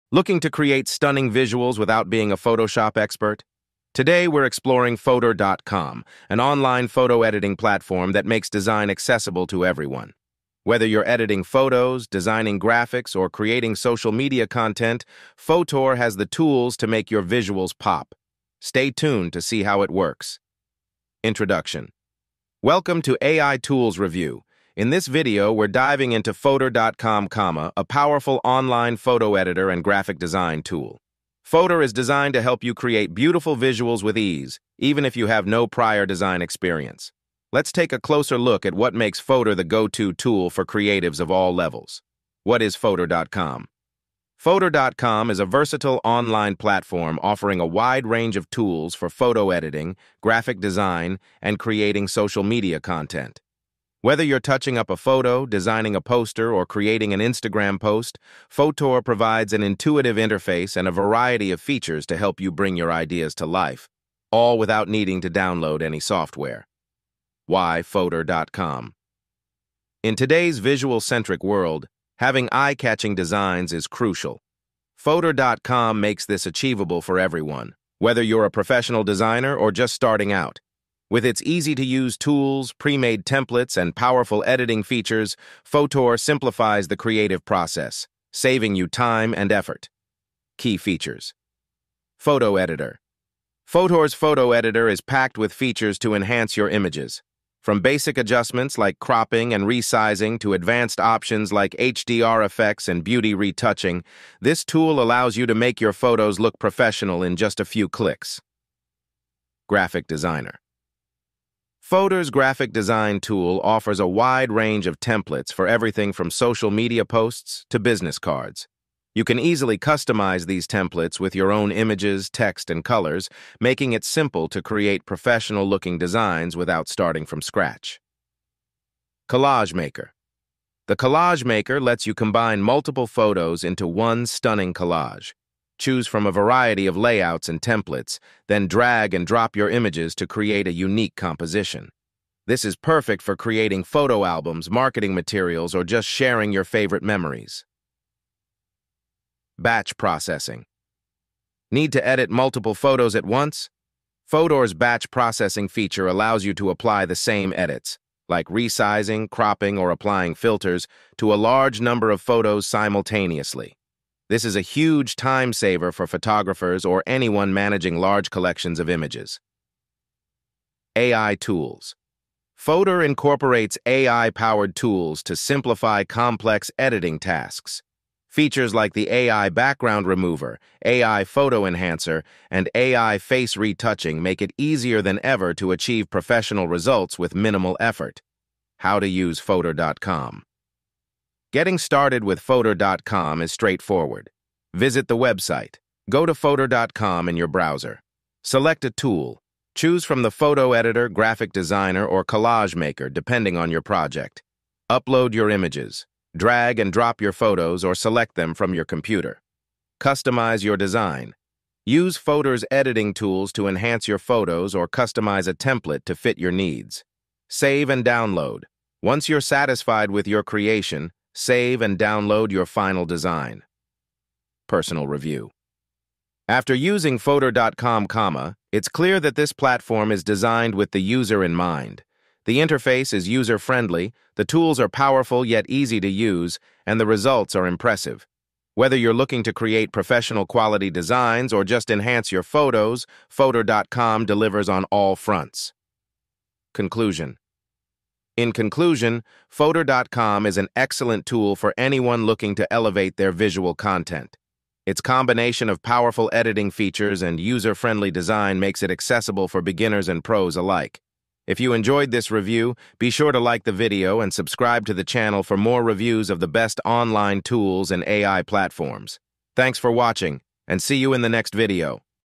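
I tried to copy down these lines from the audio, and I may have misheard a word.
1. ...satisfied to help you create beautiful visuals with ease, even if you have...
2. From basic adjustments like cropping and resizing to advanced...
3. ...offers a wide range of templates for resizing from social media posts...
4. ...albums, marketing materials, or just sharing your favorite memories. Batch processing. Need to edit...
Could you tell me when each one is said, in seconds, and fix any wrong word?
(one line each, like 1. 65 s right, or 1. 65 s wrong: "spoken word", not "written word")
1. 31 s wrong: "designed", not "satisfied"
2. 97 s right
3. 113 s wrong: "everything", not "resizing"
4. 144 s right.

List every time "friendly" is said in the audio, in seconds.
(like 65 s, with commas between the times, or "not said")
233 s, 257 s.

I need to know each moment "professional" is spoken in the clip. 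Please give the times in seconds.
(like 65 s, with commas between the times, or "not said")
78 s, 106 s, 125 s, 186 s, 239 s.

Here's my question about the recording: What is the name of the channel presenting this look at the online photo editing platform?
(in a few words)
AI Tools Review.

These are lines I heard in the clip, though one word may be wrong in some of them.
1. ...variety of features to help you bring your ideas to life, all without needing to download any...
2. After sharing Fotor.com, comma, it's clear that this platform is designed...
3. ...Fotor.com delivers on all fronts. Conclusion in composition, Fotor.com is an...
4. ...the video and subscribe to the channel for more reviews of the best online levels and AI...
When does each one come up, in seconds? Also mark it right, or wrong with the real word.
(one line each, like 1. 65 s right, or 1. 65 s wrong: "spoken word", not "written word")
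1. 60 s right
2. 226 s wrong: "using", not "sharing"
3. 243 s wrong: "conclusion", not "composition"
4. 263 s wrong: "tools", not "levels".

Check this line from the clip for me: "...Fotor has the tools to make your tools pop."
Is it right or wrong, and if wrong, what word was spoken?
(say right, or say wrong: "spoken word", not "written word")
wrong: "visuals", not "tools".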